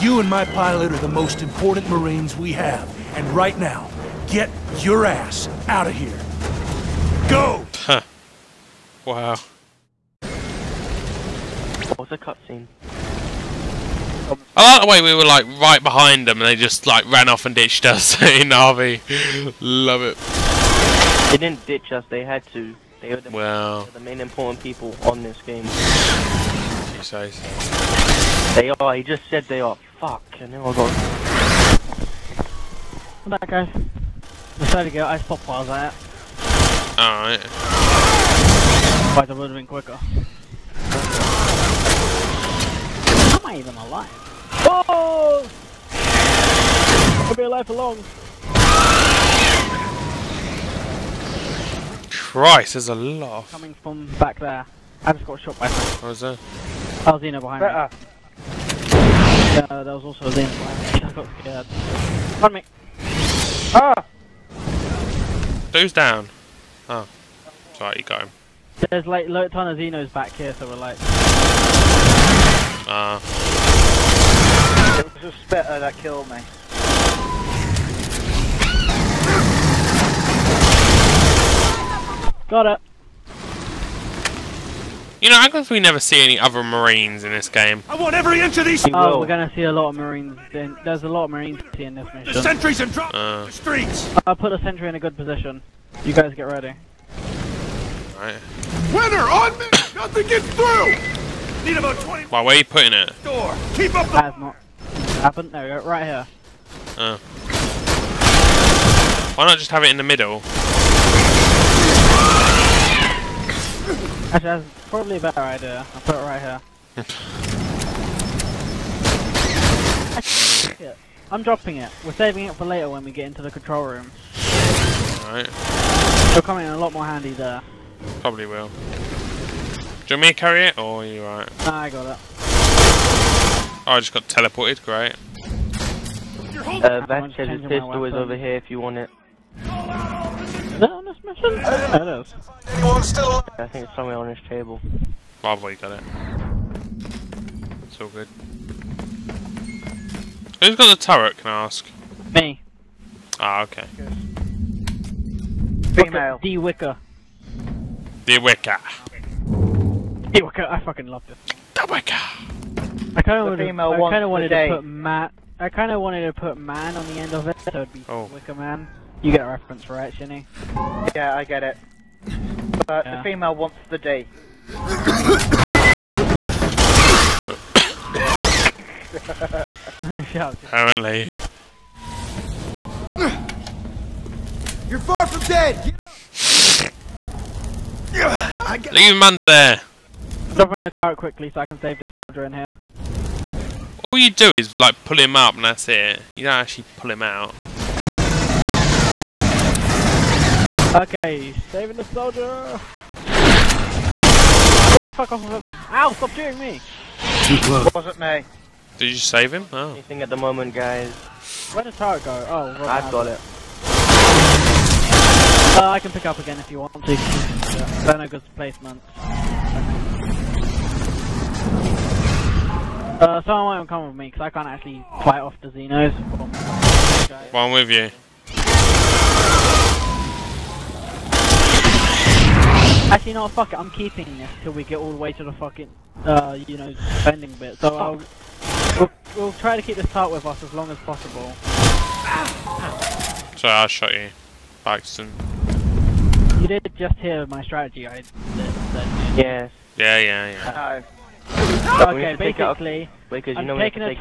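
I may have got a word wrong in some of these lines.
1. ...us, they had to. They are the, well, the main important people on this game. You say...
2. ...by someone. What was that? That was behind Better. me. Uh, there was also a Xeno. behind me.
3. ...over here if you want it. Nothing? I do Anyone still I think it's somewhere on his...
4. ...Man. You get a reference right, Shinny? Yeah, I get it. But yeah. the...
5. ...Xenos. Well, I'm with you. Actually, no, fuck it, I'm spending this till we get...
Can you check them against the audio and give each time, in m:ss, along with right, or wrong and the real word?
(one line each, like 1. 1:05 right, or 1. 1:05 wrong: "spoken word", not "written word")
1. 0:21 right
2. 0:55 right
3. 2:18 right
4. 2:48 right
5. 3:45 wrong: "keeping", not "spending".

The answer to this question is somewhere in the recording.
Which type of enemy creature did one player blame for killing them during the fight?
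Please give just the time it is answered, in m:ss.
1:15.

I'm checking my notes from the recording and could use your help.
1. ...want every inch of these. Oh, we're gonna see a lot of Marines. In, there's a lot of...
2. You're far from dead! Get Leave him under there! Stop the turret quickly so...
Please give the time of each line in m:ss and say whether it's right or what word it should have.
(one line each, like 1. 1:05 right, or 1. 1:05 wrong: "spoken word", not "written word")
1. 1:27 right
2. 3:04 right.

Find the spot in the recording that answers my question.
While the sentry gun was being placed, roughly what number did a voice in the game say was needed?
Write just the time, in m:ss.
1:42.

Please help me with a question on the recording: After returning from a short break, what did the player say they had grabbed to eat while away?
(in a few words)
Ice pop.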